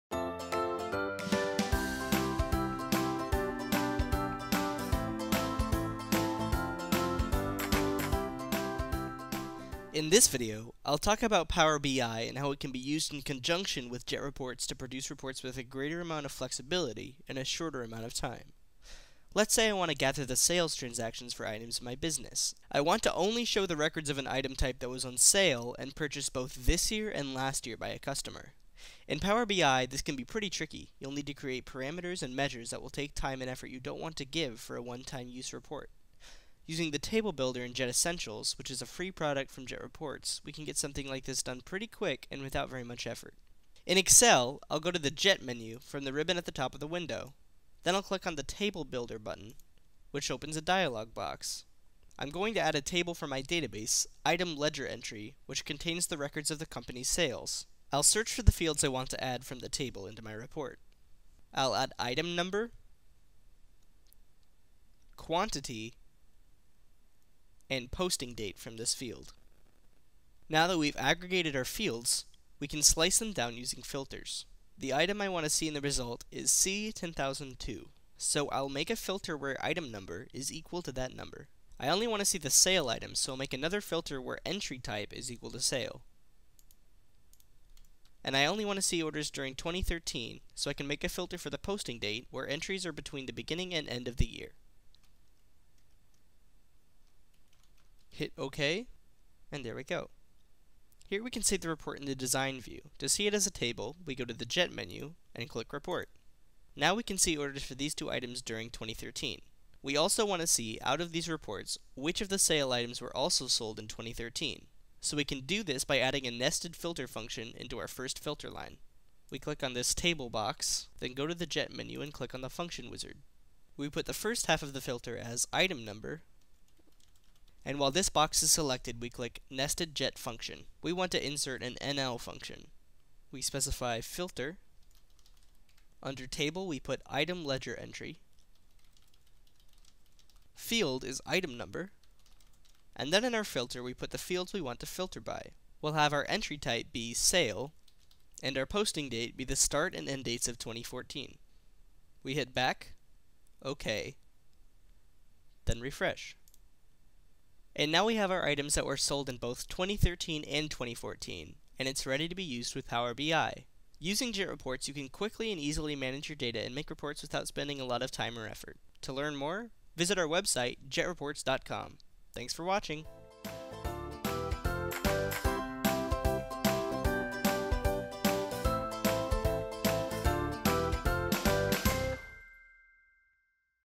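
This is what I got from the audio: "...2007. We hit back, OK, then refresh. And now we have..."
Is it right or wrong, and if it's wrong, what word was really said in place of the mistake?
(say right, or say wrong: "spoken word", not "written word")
wrong: "2014", not "2007".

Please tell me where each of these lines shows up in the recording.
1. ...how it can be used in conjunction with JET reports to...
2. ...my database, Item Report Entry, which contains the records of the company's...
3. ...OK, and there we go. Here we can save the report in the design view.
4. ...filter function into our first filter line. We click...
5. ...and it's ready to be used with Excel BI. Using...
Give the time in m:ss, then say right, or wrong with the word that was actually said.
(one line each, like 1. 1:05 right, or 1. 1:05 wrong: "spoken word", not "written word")
1. 0:12 right
2. 0:53 wrong: "Ledger", not "Report"
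3. 1:38 right
4. 1:56 right
5. 2:41 wrong: "Power", not "Excel".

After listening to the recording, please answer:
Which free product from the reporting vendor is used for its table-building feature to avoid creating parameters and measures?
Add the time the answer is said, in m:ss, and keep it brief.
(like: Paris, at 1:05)
Jet Essentials, at 0:37.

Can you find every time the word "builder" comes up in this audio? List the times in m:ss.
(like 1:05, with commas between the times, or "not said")
0:37, 0:48.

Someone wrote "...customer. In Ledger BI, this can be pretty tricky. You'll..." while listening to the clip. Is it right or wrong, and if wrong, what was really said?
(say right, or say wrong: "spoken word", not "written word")
wrong: "Power", not "Ledger".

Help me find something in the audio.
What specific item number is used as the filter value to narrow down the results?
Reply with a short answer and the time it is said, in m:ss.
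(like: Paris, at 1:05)
C10002, at 1:16.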